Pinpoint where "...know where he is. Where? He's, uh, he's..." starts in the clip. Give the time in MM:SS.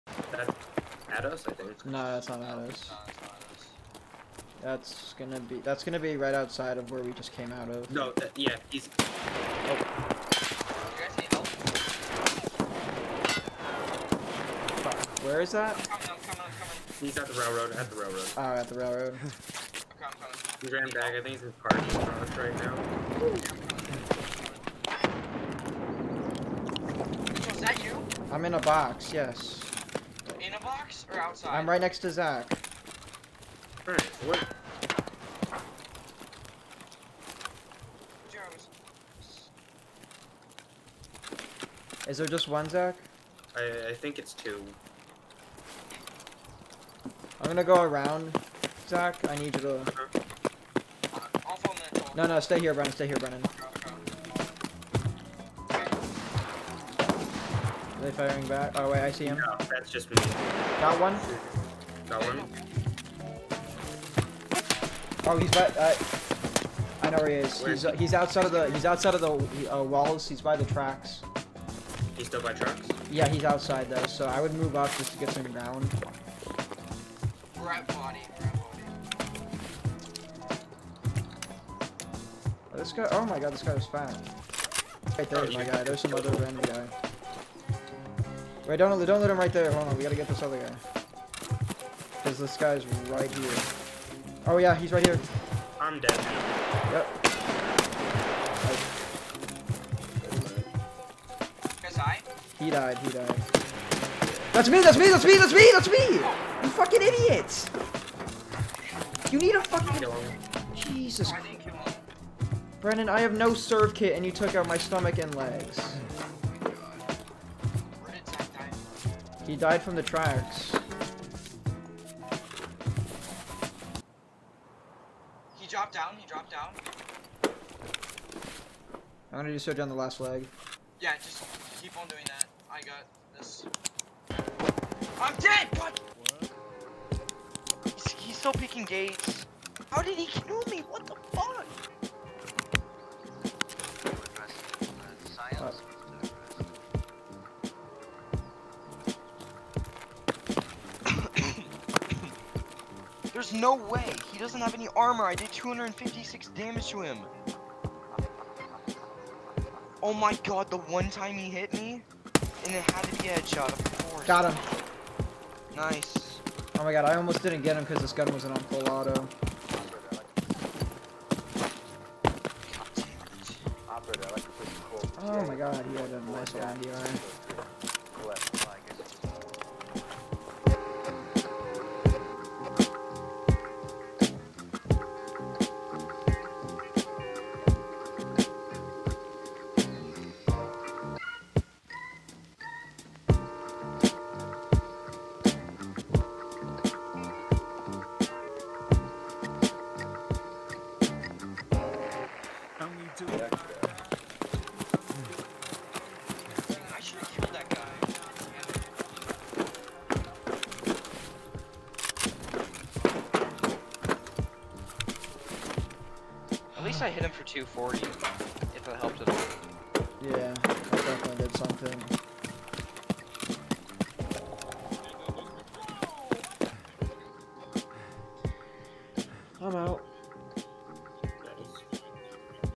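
01:07.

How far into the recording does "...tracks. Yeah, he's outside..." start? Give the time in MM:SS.
01:12.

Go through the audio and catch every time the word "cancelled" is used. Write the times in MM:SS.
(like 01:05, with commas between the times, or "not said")
not said.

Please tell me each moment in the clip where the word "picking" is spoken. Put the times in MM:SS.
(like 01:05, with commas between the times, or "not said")
02:18.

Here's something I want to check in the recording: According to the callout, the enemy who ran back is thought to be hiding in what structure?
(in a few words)
Parking garage.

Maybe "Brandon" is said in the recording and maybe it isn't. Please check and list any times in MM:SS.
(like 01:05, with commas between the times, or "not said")
01:52.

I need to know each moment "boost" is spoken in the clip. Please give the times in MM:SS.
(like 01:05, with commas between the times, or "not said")
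not said.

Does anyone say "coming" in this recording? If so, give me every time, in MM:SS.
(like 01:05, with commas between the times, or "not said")
00:15, 00:20.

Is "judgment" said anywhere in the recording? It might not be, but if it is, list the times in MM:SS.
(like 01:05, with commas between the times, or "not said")
not said.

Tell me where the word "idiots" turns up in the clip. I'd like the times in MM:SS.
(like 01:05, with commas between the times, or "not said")
01:47.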